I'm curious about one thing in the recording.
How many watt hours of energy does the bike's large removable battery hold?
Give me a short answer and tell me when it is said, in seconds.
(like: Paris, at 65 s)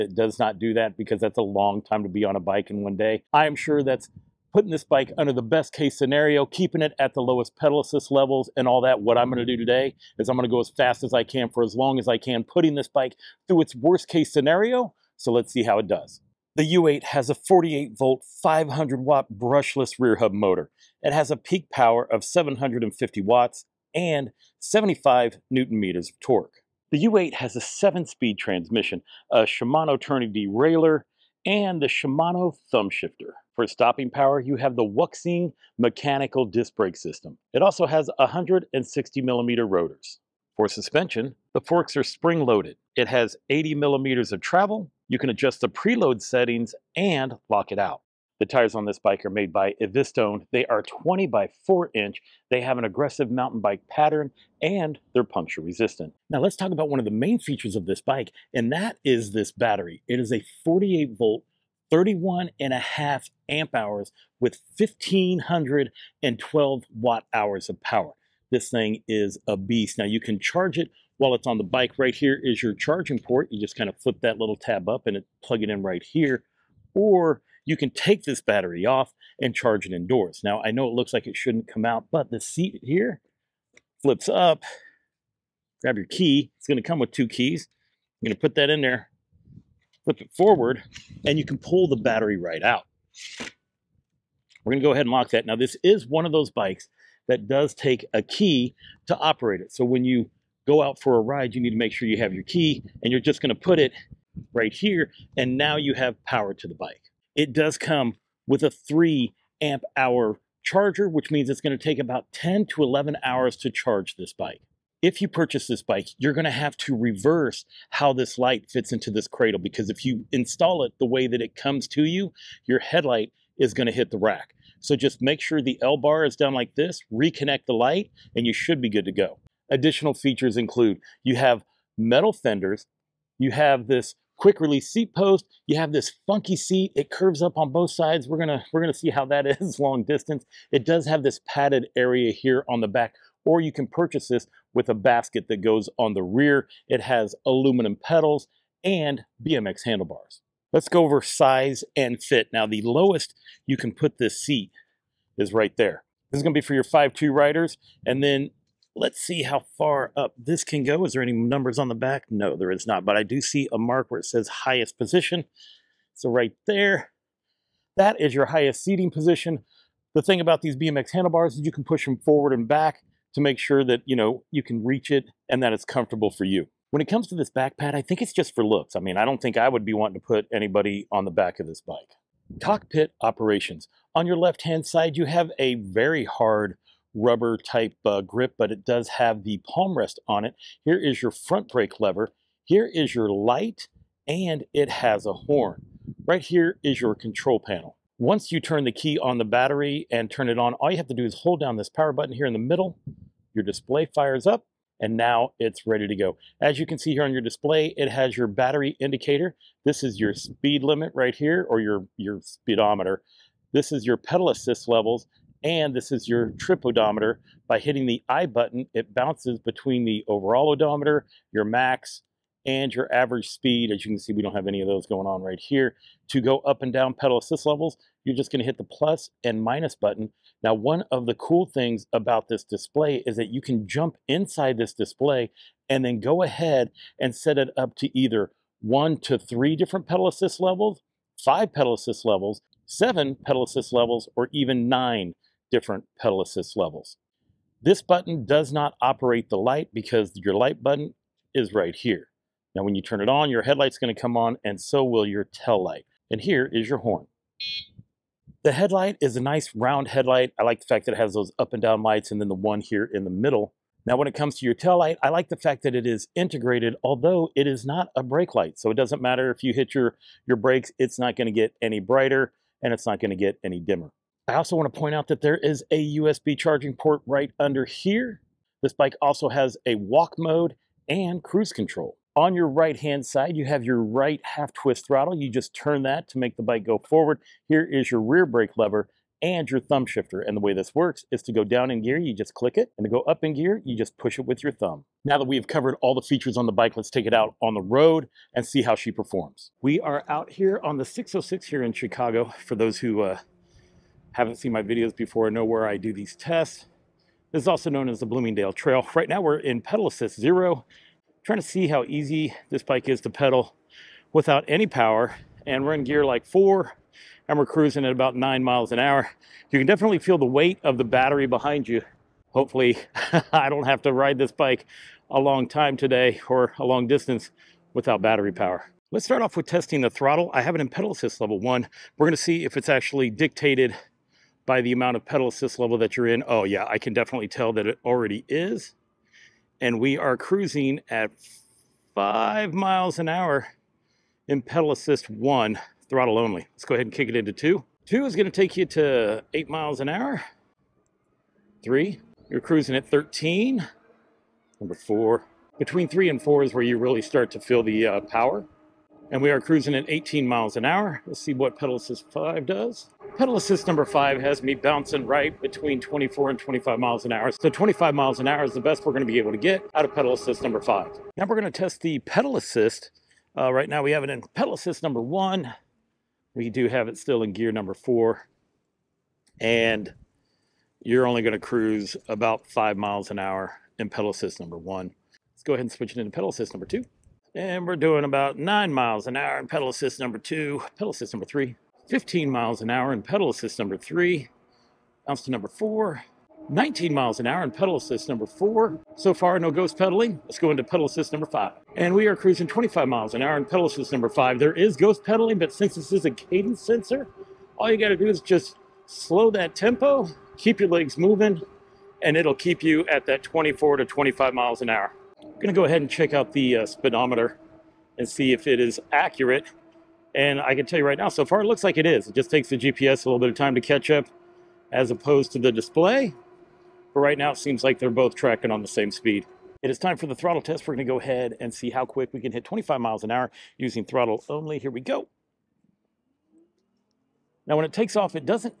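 1512, at 64 s.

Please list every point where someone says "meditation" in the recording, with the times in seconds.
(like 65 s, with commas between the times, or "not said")
not said.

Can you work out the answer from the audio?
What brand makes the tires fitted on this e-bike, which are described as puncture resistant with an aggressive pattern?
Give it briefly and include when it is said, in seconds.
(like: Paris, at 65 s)
Evistone, at 49 s.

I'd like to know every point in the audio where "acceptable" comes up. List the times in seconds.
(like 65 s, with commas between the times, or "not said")
not said.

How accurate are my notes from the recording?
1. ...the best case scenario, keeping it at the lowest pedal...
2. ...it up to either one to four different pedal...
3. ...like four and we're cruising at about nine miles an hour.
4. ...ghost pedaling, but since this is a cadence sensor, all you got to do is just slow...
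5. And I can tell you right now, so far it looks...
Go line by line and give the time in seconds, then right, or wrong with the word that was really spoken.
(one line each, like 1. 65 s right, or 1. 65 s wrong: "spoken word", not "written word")
1. 5 s right
2. 237 s wrong: "three", not "four"
3. 316 s right
4. 404 s right
5. 420 s right.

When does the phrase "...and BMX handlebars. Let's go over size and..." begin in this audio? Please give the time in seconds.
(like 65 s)
148 s.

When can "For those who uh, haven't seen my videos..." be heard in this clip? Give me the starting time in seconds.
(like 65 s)
302 s.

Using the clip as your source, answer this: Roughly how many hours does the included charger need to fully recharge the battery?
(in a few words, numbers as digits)
10 to 11 hours.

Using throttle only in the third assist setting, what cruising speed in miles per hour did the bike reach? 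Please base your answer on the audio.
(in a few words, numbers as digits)
13.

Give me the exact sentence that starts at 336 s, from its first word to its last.
Oh yeah, I can definitely tell that it already is.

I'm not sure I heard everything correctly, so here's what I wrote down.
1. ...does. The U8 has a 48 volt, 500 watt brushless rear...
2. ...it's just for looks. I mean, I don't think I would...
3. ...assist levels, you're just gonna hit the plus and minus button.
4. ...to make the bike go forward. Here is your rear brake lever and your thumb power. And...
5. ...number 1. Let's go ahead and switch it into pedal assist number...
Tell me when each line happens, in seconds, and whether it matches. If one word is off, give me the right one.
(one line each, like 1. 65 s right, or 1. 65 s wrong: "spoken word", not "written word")
1. 15 s right
2. 178 s right
3. 227 s right
4. 286 s wrong: "shifter", not "power"
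5. 384 s right.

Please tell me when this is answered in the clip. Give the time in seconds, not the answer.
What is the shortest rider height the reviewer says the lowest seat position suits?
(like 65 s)
156 s.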